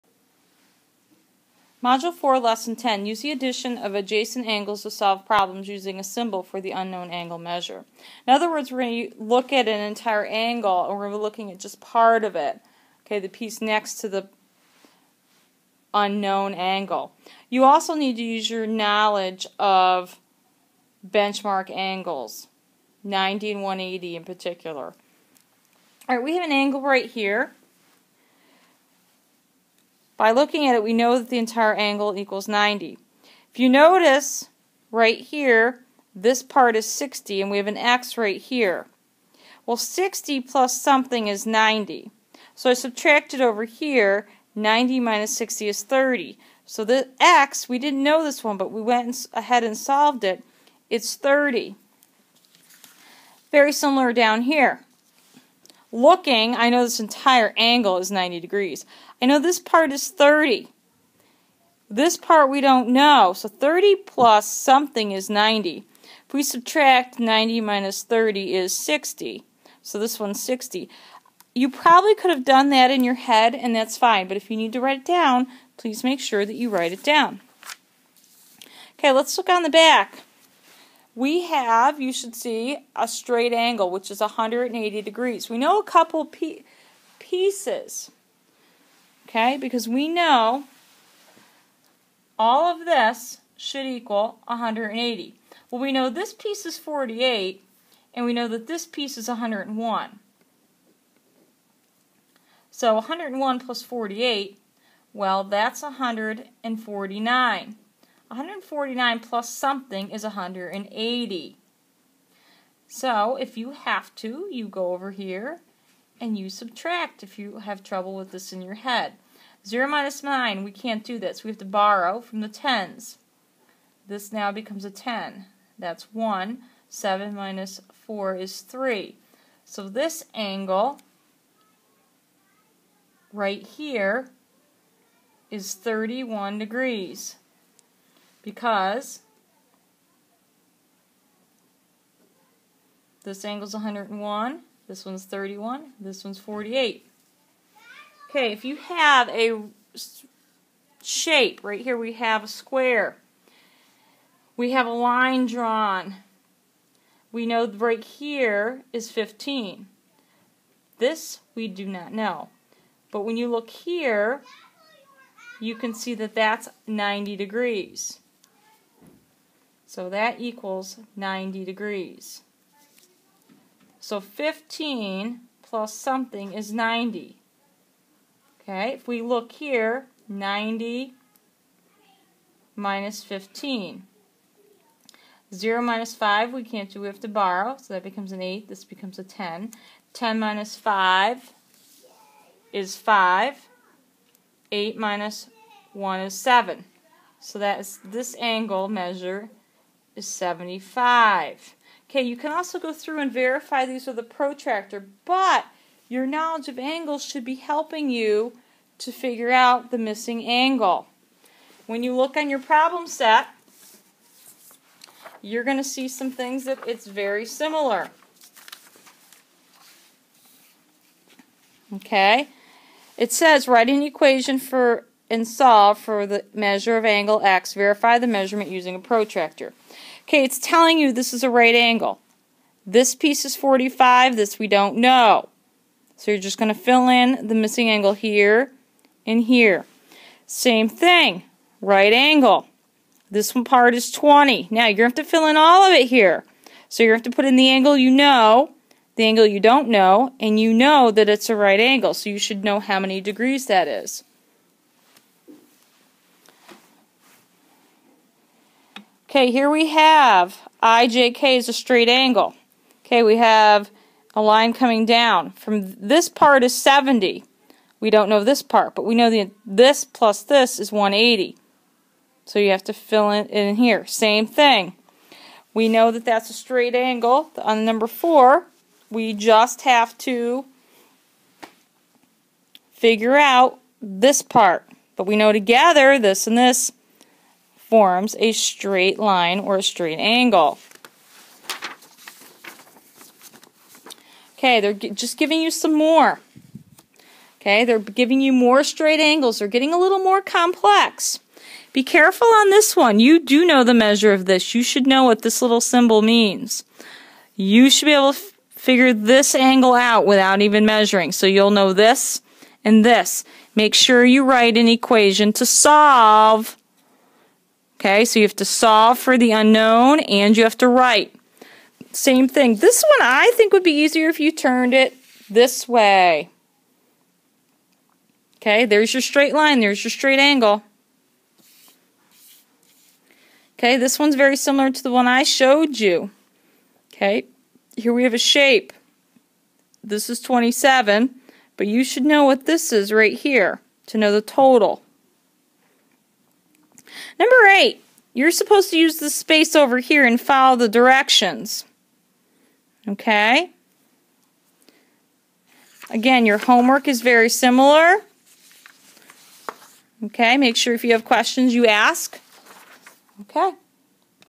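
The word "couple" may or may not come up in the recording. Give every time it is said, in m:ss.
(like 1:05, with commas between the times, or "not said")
1:25.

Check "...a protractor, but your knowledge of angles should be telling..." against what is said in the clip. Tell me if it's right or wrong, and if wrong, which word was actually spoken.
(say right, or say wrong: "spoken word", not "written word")
wrong: "helping", not "telling".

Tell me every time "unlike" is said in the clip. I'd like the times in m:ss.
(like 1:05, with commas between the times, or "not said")
not said.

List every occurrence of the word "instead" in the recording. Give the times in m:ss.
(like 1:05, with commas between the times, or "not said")
not said.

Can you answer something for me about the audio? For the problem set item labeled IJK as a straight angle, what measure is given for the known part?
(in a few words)
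70.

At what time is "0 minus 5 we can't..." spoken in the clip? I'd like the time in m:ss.
3:05.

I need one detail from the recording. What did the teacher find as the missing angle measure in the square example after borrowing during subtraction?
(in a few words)
75.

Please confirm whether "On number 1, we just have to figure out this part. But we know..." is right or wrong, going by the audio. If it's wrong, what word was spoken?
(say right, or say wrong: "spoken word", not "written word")
wrong: "4", not "1".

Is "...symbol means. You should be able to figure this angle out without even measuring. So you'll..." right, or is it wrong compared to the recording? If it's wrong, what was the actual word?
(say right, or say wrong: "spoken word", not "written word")
right.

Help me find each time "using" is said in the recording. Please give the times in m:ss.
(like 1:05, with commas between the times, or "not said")
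0:05, 3:48.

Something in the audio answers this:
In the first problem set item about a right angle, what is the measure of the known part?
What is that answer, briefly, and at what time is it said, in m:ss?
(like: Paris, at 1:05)
45, at 3:53.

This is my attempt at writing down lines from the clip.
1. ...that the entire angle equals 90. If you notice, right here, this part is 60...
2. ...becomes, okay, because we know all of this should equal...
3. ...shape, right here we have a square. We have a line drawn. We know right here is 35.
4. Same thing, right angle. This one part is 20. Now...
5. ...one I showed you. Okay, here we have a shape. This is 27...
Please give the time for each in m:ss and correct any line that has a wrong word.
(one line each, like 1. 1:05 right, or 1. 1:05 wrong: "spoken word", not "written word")
1. 0:31 right
2. 1:27 wrong: "pieces", not "becomes"
3. 2:31 wrong: "15", not "35"
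4. 4:00 right
5. 5:35 right.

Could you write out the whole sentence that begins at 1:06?
If we subtract 90 minus 30 is 60.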